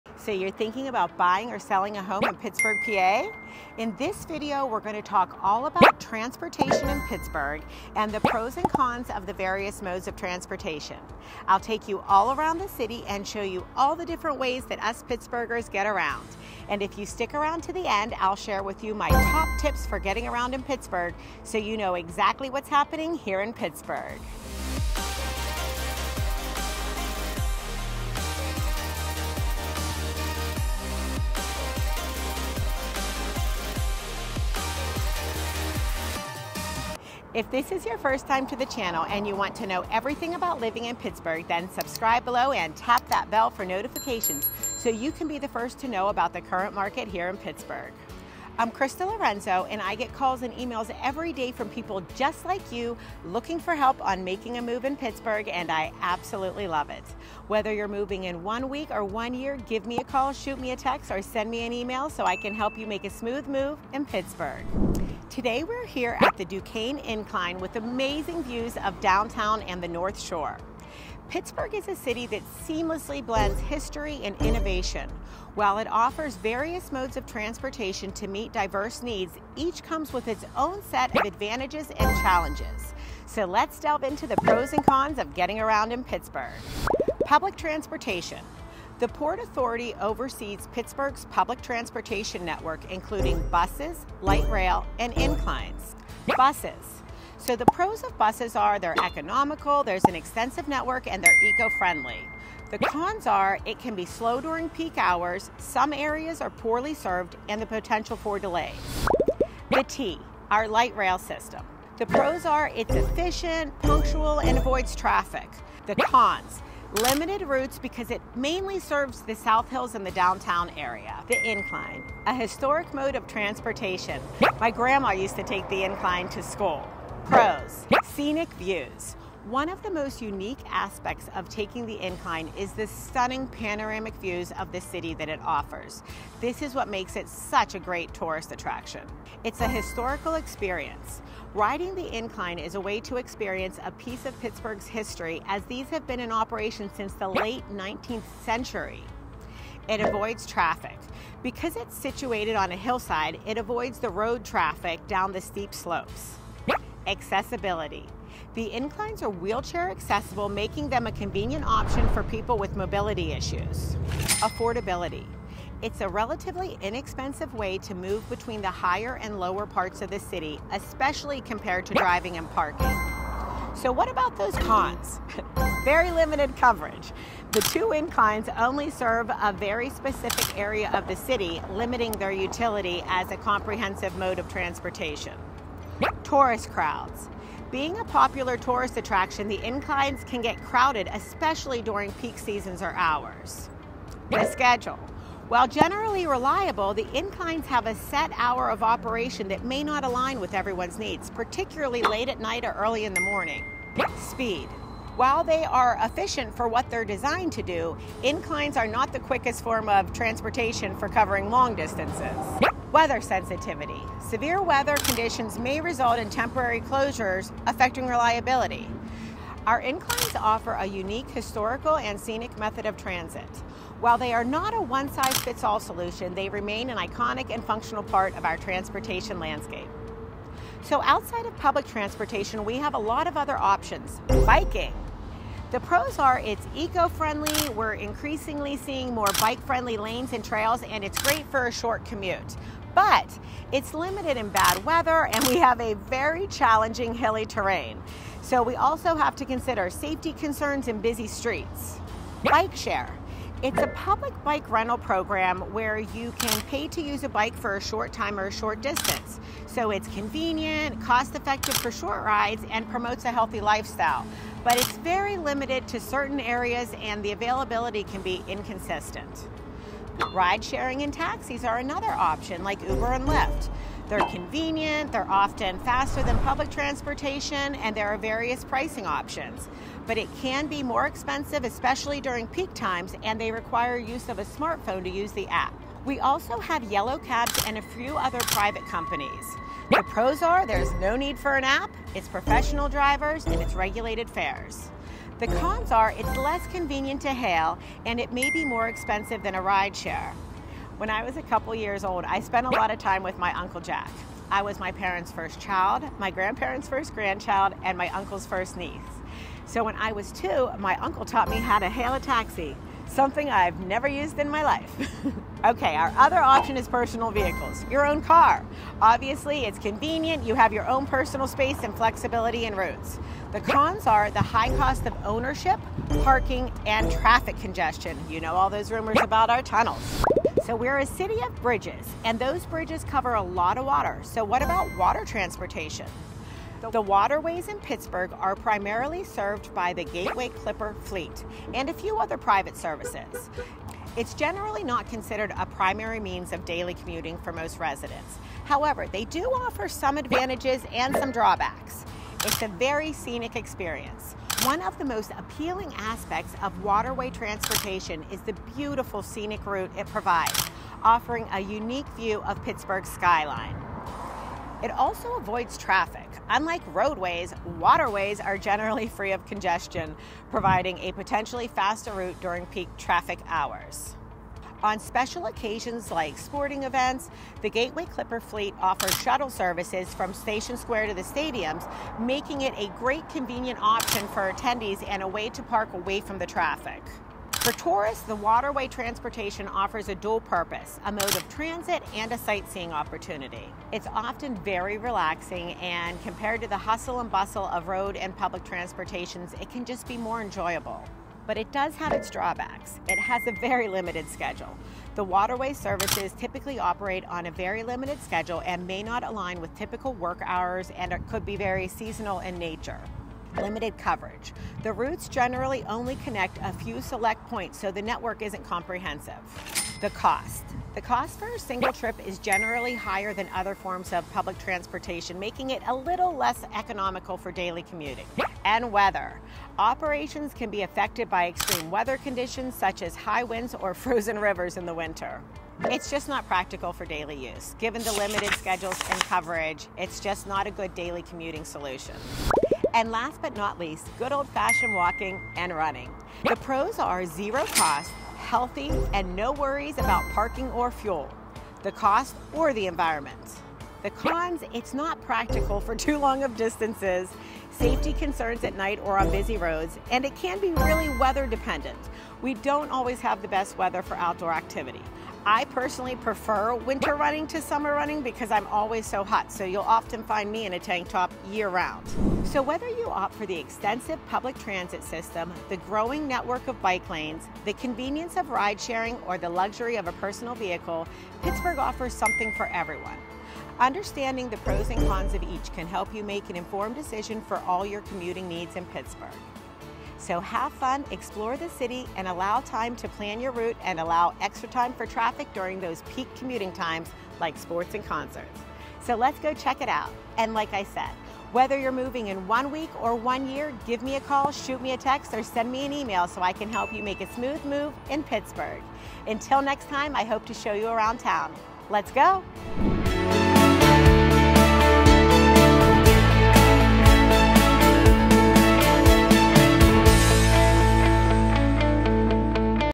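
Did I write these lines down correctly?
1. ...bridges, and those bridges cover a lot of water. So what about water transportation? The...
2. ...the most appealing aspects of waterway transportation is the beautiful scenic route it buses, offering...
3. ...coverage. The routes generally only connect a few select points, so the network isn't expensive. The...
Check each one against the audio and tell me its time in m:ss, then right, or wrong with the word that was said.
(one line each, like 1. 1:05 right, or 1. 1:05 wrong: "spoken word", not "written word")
1. 5:31 right
2. 5:54 wrong: "provides", not "buses"
3. 6:53 wrong: "comprehensive", not "expensive".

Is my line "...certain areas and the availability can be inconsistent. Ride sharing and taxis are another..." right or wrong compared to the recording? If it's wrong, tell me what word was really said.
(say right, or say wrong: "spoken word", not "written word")
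right.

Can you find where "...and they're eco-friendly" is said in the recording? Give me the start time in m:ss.
1:41.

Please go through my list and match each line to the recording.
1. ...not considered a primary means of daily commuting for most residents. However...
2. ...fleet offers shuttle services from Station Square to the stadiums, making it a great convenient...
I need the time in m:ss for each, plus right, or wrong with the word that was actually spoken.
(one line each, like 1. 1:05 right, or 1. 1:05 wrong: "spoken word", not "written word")
1. 5:44 right
2. 6:18 right.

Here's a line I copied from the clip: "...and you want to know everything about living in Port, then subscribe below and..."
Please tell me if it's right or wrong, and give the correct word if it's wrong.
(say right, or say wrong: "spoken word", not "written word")
wrong: "Pittsburgh", not "Port".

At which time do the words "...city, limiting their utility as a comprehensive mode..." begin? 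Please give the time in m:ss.
3:01.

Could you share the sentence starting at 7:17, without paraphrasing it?
Given the limited schedules and coverage, it's just not a good daily commuting solution.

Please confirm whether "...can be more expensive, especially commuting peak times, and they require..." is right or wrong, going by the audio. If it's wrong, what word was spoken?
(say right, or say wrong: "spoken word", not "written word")
wrong: "during", not "commuting".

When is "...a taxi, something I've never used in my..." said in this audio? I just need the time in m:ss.
5:12.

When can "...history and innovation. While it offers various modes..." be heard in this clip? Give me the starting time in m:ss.
1:13.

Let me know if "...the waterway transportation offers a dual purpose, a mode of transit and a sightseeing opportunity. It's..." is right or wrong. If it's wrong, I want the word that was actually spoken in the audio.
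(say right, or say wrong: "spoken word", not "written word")
right.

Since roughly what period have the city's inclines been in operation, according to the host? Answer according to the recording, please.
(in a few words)
late 19th century.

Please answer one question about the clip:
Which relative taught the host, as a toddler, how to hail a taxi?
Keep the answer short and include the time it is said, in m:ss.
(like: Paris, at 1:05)
Uncle Jack, at 5:03.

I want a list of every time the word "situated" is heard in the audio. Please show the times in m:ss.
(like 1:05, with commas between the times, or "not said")
2:31.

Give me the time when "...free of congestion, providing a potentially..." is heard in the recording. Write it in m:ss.
6:09.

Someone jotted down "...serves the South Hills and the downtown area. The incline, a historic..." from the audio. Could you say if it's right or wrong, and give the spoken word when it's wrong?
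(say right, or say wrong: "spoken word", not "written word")
right.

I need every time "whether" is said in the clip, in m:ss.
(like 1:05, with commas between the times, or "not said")
0:57, 7:52, 8:21.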